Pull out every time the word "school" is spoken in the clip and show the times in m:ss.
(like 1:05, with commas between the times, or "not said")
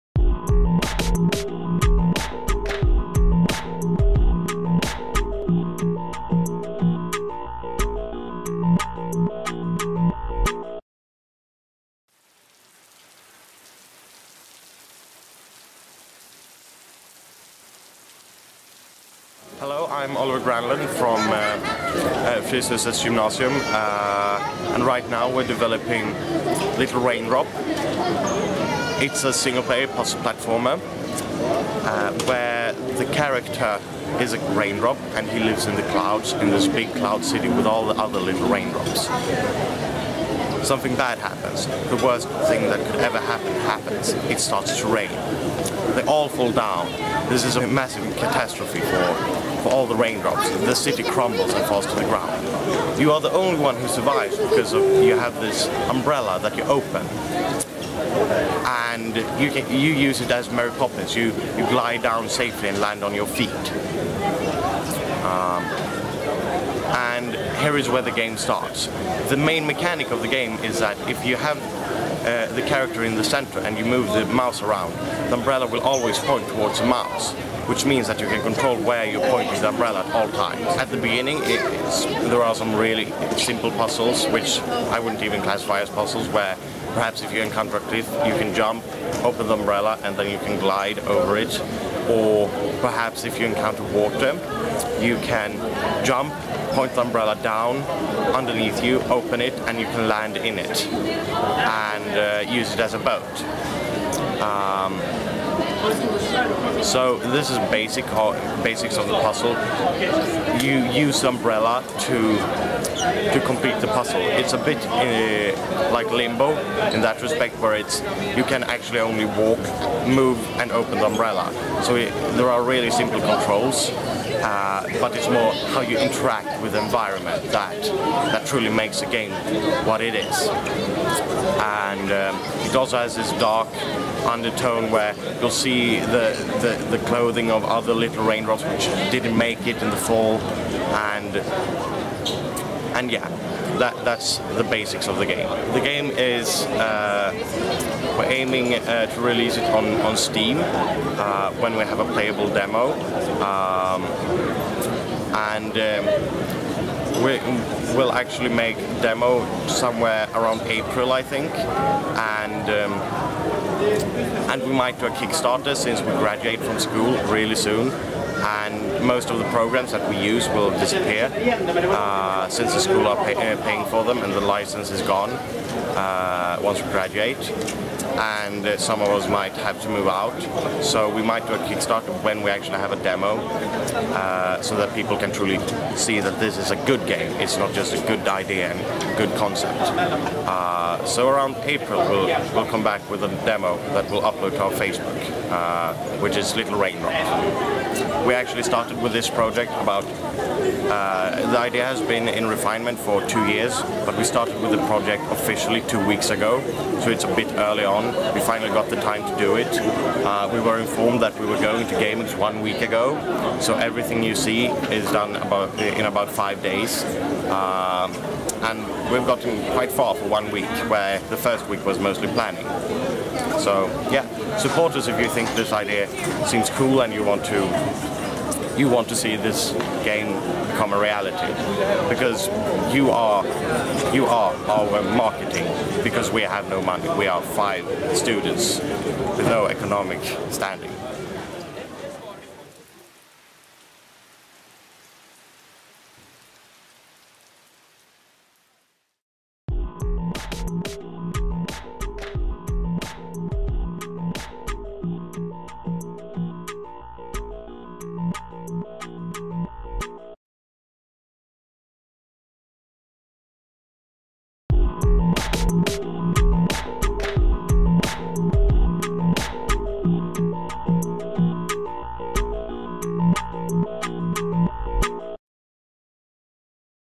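2:46, 2:52.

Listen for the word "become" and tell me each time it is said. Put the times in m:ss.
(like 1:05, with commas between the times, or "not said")
3:50.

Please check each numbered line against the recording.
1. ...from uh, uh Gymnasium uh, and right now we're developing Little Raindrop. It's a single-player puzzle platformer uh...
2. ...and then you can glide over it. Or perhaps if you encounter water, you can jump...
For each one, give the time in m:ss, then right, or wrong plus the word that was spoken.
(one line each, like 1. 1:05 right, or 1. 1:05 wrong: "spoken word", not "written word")
1. 0:20 right
2. 1:30 right.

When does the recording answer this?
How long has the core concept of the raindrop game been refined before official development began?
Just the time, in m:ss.
3:23.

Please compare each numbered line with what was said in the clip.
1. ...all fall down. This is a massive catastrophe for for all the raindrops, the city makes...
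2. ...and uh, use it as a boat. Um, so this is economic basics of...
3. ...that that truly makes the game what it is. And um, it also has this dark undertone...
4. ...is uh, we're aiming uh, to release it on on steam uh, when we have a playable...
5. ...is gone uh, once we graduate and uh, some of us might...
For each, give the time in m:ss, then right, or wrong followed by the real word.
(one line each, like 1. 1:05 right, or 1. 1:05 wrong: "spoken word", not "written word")
1. 0:46 wrong: "crumbles", not "makes"
2. 1:40 wrong: "basic", not "economic"
3. 2:07 right
4. 2:26 right
5. 2:54 right.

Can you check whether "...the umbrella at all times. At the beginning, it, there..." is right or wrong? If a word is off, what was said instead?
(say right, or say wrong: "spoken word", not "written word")
right.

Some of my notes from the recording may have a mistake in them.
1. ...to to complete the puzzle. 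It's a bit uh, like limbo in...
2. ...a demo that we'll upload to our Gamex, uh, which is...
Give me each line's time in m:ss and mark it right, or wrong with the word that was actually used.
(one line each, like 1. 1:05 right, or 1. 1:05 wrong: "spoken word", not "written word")
1. 1:52 right
2. 3:13 wrong: "Facebook", not "Gamex".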